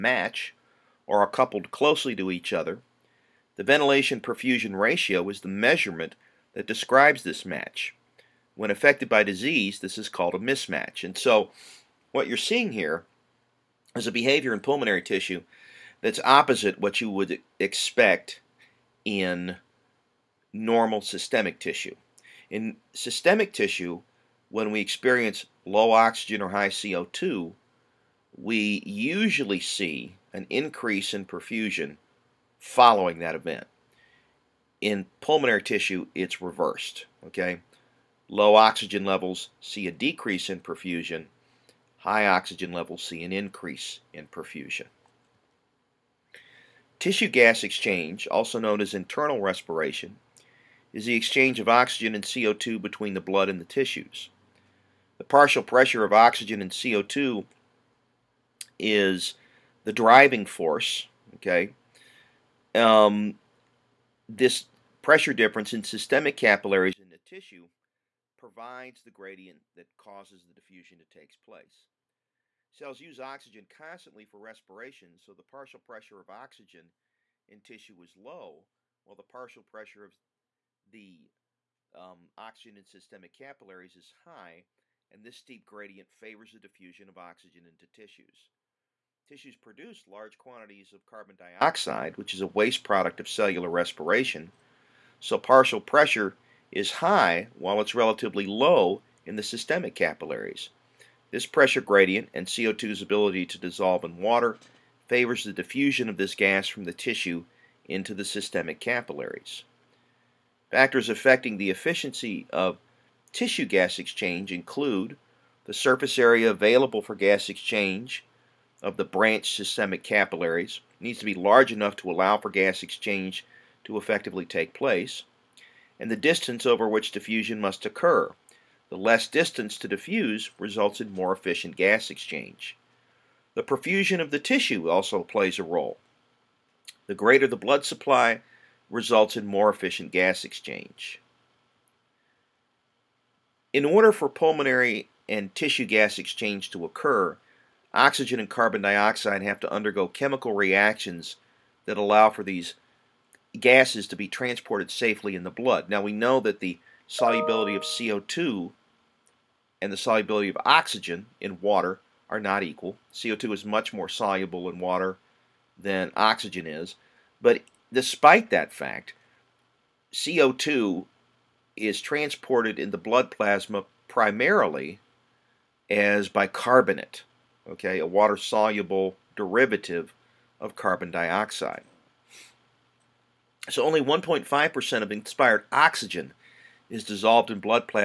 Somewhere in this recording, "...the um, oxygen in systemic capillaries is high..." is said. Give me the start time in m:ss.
1:20.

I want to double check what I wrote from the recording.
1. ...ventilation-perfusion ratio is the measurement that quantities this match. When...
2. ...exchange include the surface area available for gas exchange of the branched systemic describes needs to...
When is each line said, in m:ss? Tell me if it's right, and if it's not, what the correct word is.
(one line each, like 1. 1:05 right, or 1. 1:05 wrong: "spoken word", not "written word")
1. 0:03 wrong: "describes", not "quantities"
2. 1:53 wrong: "capillaries", not "describes".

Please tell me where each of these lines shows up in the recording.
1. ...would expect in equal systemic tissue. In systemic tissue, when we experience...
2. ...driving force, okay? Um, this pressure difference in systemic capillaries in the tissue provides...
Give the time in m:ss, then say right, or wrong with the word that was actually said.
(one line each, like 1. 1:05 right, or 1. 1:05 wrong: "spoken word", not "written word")
1. 0:17 wrong: "normal", not "equal"
2. 0:59 right.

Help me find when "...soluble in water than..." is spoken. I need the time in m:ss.
2:44.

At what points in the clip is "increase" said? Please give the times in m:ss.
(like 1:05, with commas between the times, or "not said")
0:30, 0:43.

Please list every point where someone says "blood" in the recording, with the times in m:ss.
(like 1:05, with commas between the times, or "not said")
0:53, 2:17, 2:35, 2:52.